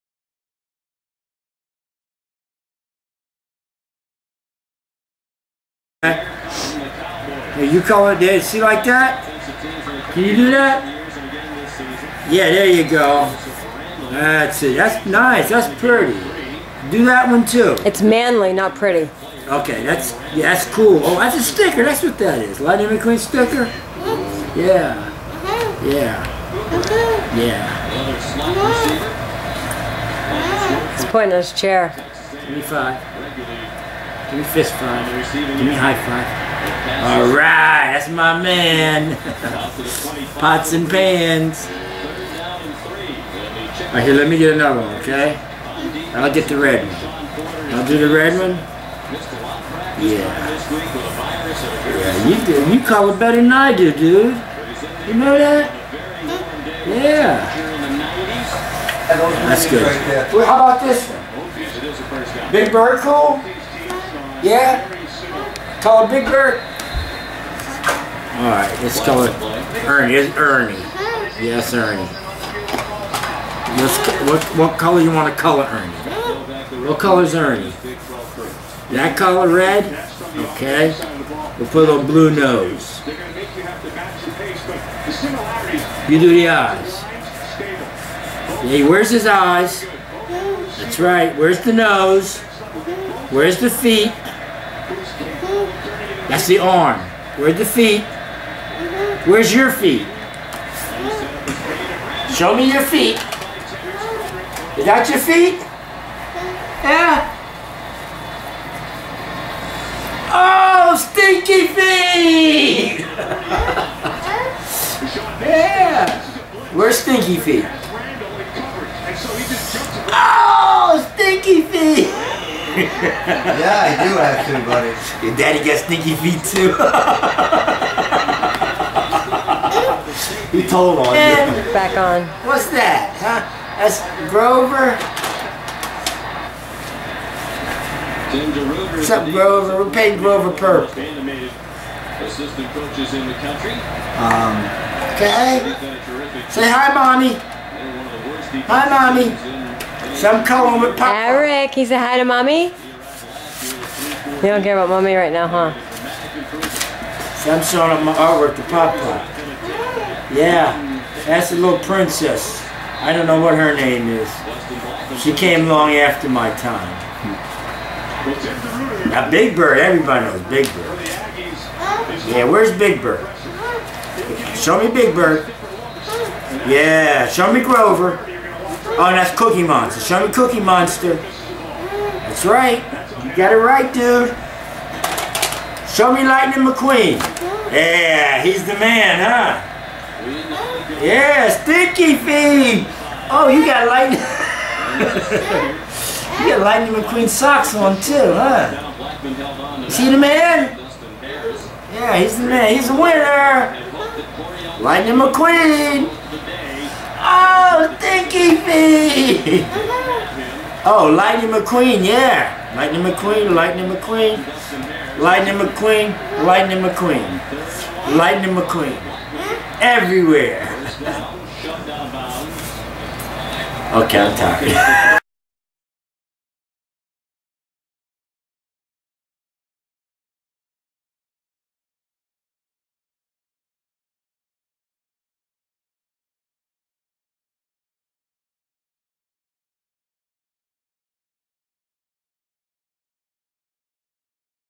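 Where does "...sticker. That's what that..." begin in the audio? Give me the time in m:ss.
0:21.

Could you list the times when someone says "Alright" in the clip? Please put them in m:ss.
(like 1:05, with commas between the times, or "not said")
0:37, 0:43, 1:08.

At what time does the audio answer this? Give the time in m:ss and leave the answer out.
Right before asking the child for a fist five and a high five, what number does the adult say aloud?
0:32.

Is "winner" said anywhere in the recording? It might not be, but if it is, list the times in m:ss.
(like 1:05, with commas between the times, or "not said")
3:22.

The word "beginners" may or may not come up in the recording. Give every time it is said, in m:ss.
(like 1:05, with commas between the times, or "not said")
not said.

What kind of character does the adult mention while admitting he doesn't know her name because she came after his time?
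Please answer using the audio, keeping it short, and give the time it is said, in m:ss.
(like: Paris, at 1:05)
princess, at 2:41.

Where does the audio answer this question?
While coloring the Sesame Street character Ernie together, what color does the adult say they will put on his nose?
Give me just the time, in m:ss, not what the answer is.
1:22.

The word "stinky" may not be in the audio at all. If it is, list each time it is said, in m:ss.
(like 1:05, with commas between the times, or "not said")
1:50, 1:56, 2:01, 2:05, 3:11.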